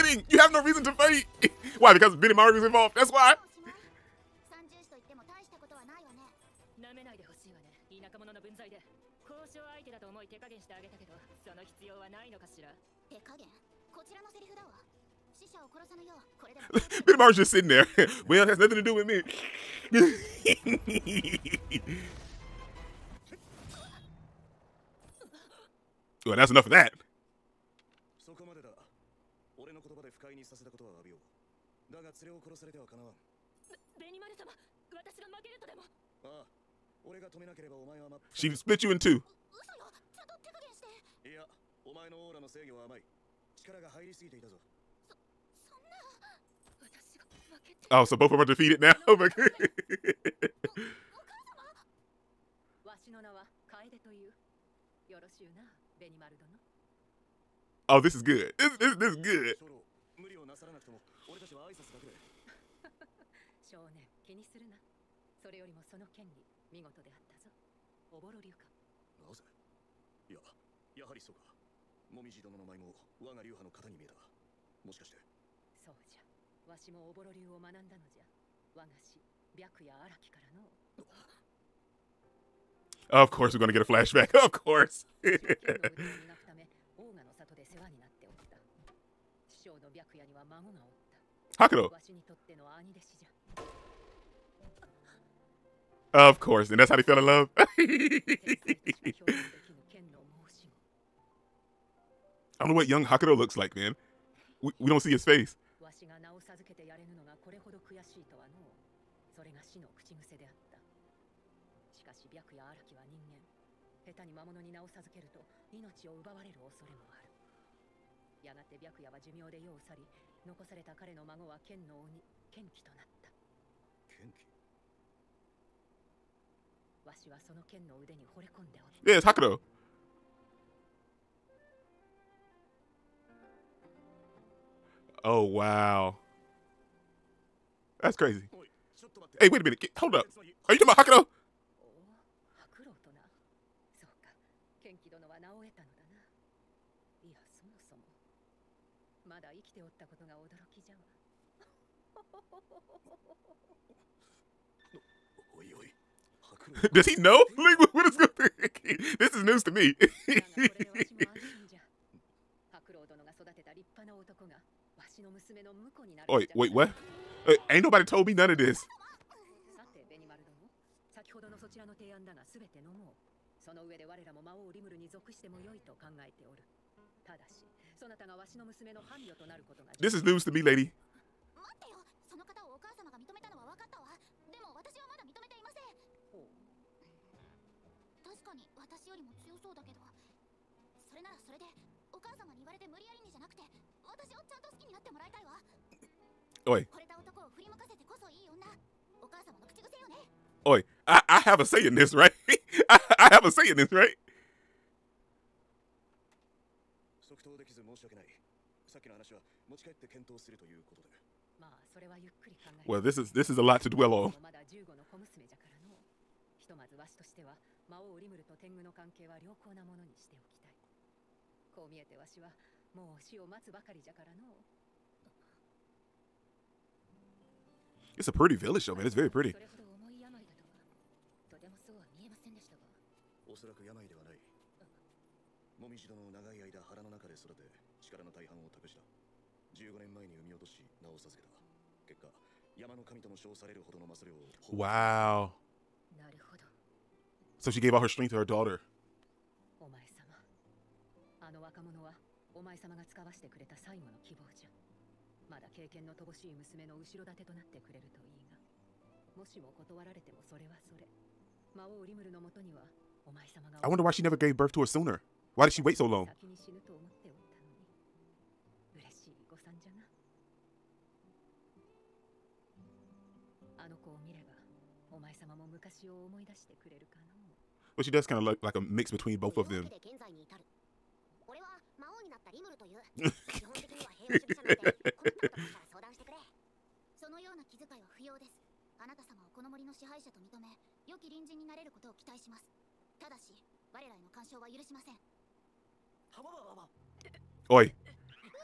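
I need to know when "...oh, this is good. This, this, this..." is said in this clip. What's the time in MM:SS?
00:57.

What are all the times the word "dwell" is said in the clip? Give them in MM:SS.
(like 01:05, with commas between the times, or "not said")
03:33.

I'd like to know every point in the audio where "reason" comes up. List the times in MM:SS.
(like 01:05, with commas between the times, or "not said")
00:00.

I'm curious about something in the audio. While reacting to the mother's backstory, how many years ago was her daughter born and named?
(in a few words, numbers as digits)
15.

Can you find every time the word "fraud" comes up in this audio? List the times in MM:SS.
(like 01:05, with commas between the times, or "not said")
not said.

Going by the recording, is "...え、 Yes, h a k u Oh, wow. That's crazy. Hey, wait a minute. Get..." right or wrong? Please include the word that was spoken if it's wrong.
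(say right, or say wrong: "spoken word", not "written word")
right.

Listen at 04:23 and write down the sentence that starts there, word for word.
I wonder why she never gave birth to her sooner.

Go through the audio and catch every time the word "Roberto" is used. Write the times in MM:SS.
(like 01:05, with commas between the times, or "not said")
not said.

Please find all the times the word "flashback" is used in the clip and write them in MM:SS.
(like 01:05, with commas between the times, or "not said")
01:23.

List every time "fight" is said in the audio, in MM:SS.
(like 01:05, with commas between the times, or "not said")
00:00.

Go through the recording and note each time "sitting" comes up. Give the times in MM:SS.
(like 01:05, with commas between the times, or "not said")
00:17.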